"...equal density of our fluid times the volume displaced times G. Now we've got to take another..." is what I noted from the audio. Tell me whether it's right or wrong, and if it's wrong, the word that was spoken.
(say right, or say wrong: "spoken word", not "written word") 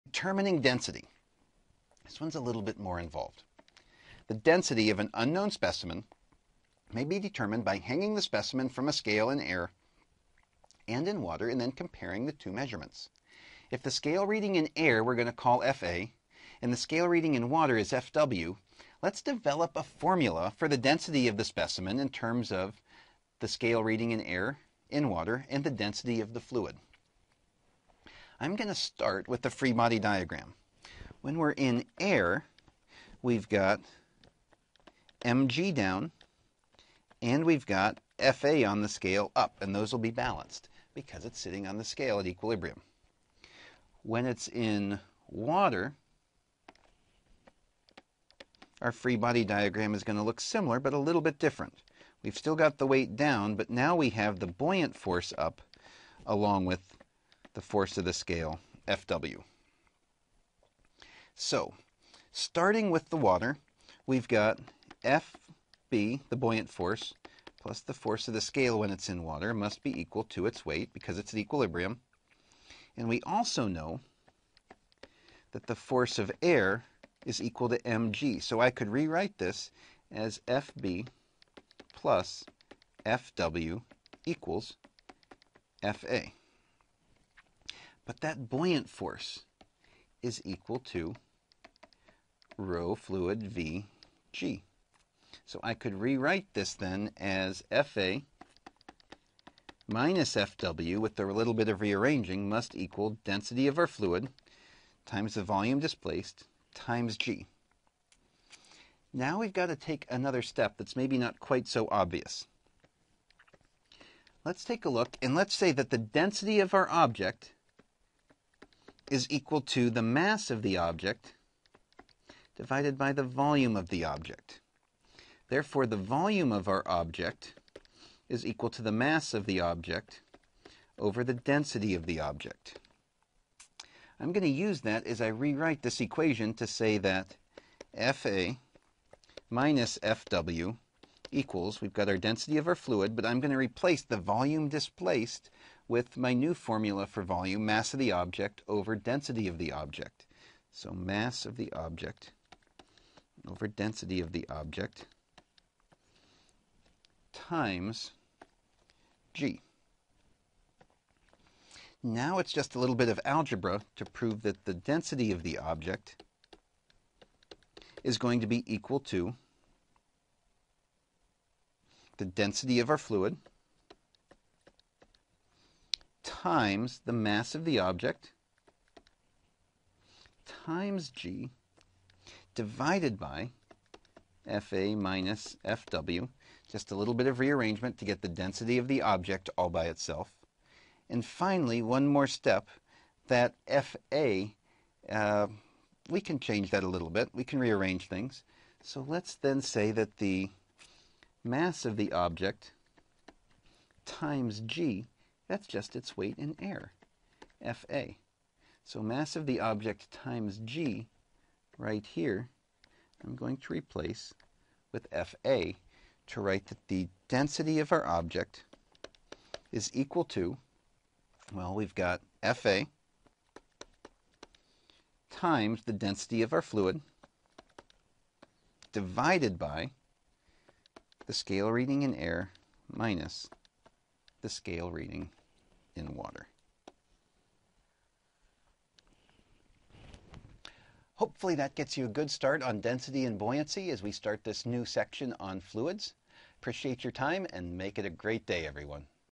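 right.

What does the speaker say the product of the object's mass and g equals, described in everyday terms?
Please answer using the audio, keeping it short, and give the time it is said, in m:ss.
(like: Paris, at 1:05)
its weight in air, at 3:25.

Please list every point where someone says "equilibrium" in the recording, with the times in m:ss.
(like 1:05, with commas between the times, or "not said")
0:42, 1:11.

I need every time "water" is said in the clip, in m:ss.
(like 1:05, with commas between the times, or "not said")
0:11, 0:17, 0:25, 0:45, 1:03, 1:09, 3:56.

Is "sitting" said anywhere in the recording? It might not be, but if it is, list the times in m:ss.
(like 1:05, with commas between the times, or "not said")
0:41.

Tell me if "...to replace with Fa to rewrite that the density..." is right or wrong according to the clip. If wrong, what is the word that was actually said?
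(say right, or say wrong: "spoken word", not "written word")
wrong: "write", not "rewrite".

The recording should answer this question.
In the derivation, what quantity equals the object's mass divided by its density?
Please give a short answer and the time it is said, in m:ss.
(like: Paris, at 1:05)
volume of our object, at 2:05.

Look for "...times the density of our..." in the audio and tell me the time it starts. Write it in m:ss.
3:45.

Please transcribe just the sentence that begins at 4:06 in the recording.
Appreciate your time and make it a great day, everyone.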